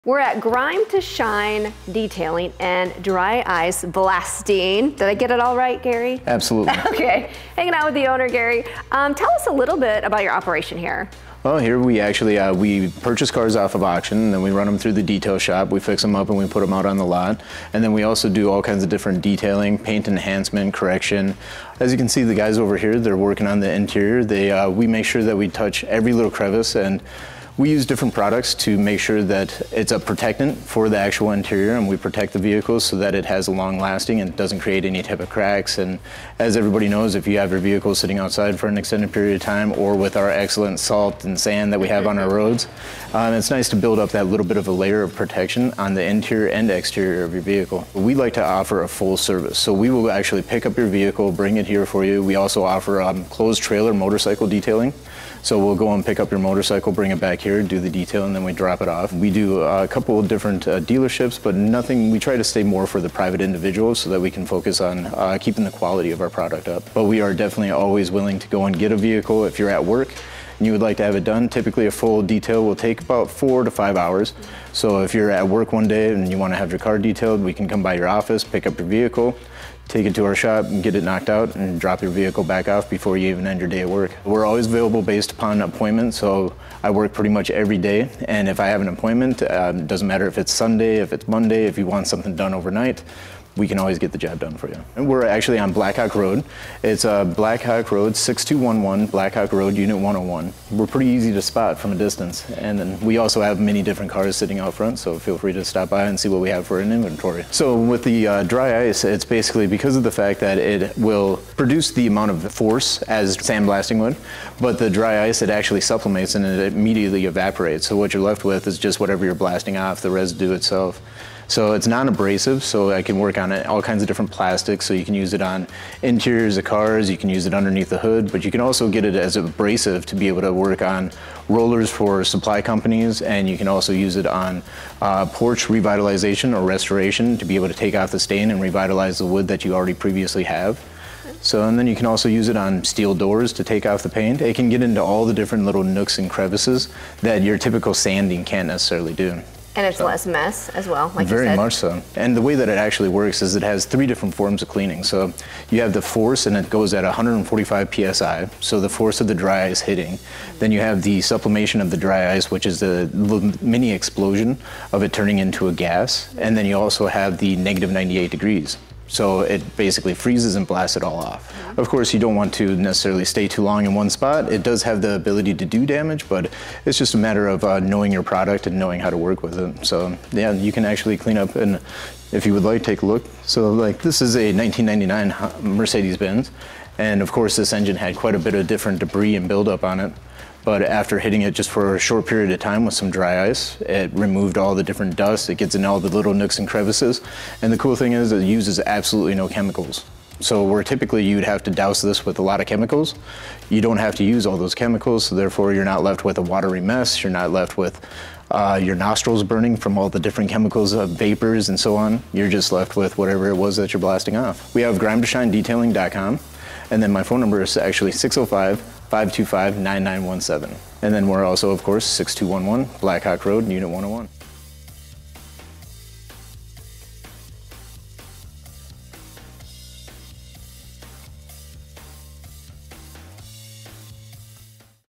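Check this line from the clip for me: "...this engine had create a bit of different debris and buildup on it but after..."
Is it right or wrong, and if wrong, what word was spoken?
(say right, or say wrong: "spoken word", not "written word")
wrong: "quite", not "create".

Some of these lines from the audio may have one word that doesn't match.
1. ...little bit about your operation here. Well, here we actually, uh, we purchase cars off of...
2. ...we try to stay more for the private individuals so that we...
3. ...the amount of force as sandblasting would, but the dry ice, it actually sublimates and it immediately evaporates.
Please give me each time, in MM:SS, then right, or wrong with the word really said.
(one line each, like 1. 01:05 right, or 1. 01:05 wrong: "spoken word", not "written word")
1. 00:09 right
2. 01:02 right
3. 01:51 right.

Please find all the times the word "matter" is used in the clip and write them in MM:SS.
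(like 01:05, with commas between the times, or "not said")
01:30, 02:57.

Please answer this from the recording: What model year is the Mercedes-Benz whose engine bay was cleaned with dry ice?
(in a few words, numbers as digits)
1999.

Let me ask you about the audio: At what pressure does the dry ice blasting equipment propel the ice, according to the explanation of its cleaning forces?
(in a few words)
145 PSI.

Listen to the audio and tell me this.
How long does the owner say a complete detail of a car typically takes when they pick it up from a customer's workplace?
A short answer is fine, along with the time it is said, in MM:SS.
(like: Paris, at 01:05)
4 to 5 hours, at 01:13.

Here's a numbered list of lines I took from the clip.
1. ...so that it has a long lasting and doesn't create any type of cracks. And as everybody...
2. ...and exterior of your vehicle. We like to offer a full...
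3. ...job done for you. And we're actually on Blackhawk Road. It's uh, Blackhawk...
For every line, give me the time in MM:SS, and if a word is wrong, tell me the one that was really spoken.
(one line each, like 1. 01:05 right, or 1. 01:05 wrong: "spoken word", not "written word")
1. 00:32 right
2. 00:46 right
3. 01:34 right.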